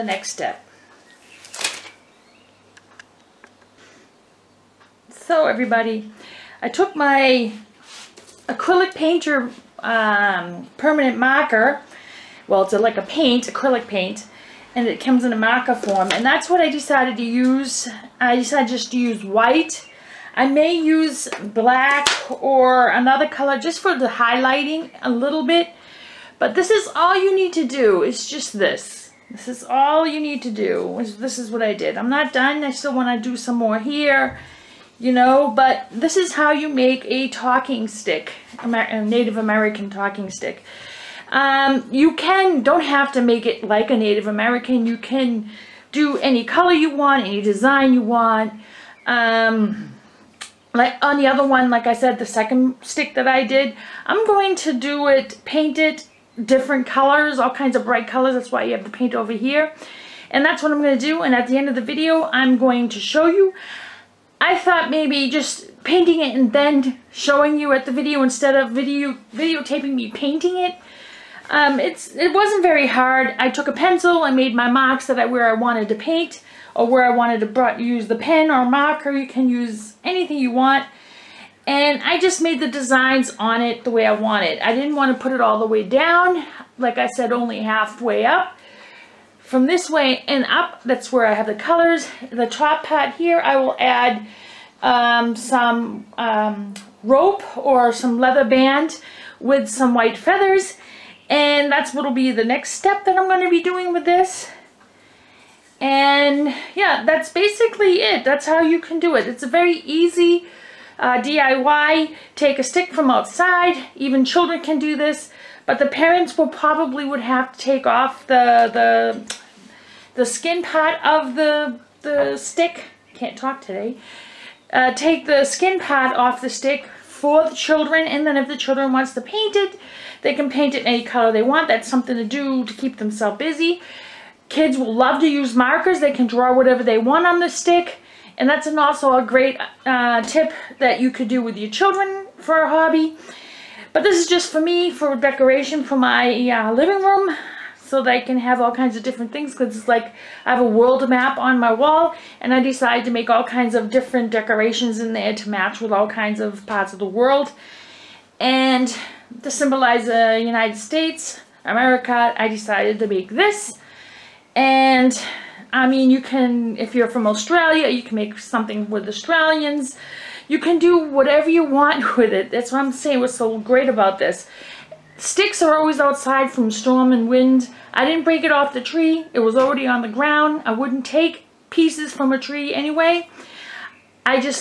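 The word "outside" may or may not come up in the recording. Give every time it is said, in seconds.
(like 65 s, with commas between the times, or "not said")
113 s, 176 s.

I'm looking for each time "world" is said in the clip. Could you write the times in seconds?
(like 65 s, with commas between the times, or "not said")
150 s, 157 s.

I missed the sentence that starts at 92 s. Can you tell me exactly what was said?
The chop pot here, I will add um, some um, rope or some leather band with some white feathers.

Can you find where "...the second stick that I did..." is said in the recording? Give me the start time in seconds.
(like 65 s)
52 s.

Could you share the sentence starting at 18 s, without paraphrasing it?
I decided just to use white.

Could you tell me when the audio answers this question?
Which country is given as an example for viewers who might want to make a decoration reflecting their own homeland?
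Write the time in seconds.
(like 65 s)
167 s.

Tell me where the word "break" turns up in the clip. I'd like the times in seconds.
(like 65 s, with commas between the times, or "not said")
178 s.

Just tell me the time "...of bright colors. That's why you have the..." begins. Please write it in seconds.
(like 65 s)
57 s.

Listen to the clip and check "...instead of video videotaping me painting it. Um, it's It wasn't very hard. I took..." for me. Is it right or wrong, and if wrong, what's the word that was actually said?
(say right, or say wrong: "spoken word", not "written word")
right.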